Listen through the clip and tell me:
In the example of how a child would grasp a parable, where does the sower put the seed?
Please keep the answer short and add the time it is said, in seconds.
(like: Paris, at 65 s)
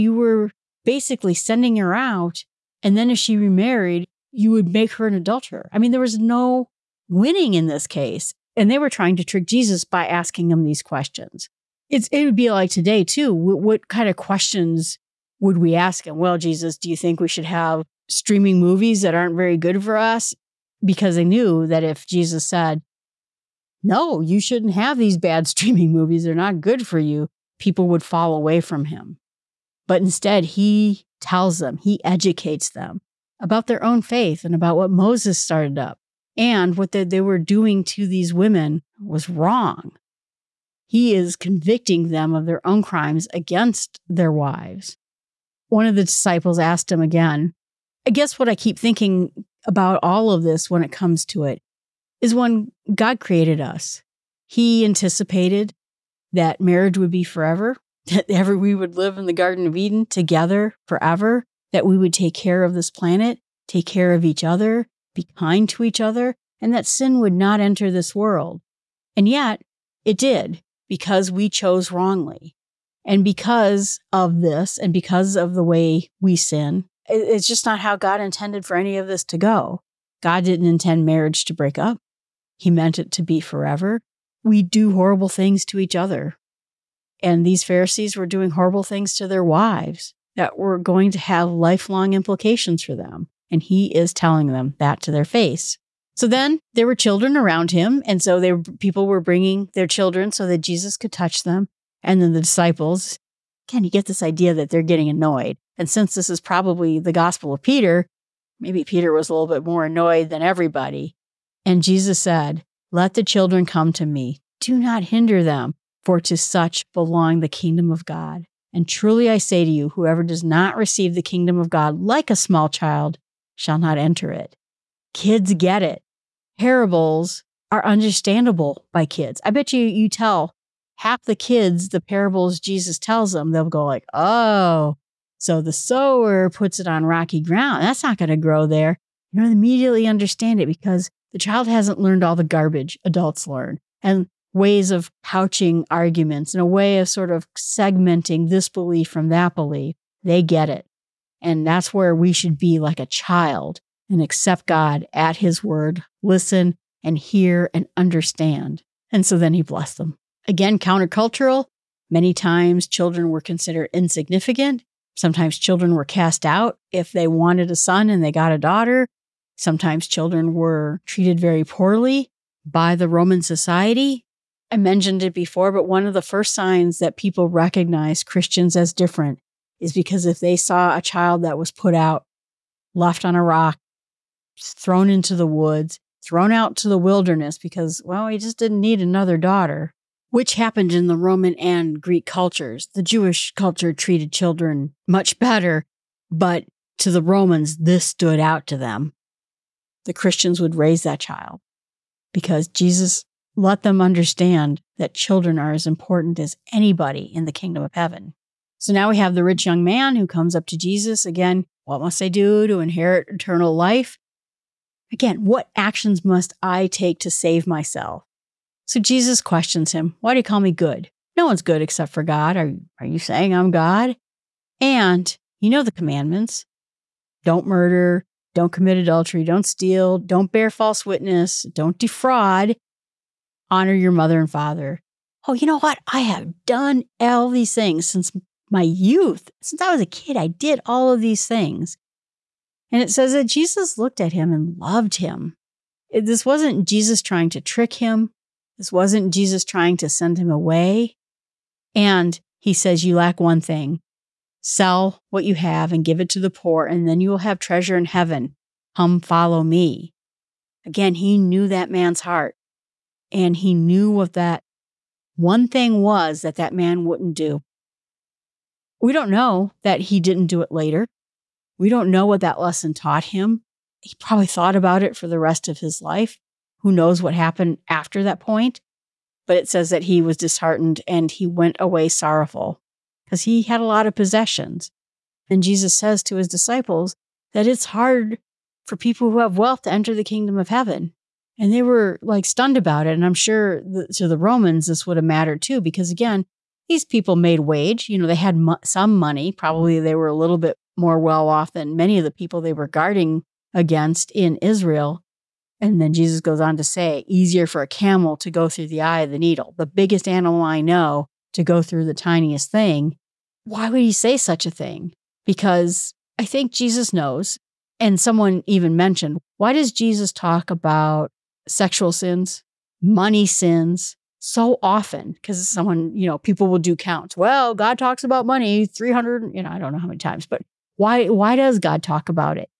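rocky ground, at 137 s.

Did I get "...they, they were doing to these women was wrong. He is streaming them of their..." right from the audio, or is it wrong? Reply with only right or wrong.
wrong.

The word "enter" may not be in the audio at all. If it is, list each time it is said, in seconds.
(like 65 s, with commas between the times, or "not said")
67 s, 123 s, 289 s.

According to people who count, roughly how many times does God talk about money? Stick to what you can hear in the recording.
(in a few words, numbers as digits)
300.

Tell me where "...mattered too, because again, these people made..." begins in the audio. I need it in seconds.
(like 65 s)
295 s.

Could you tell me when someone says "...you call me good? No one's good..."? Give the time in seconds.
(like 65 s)
220 s.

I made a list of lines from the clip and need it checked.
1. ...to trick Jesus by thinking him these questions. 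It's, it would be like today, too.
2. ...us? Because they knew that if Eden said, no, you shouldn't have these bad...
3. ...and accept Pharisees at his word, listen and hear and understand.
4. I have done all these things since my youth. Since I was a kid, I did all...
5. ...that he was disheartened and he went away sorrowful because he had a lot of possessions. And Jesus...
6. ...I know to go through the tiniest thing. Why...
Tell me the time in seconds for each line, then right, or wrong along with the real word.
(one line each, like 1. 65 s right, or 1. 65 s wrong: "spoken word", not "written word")
1. 9 s wrong: "asking", not "thinking"
2. 19 s wrong: "Jesus", not "Eden"
3. 154 s wrong: "God", not "Pharisees"
4. 236 s right
5. 279 s right
6. 310 s right.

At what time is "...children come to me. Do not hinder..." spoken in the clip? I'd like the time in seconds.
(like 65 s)
113 s.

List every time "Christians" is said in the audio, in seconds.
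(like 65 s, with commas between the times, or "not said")
178 s, 200 s.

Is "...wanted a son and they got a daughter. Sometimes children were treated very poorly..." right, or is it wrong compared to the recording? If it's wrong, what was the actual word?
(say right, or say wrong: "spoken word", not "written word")
right.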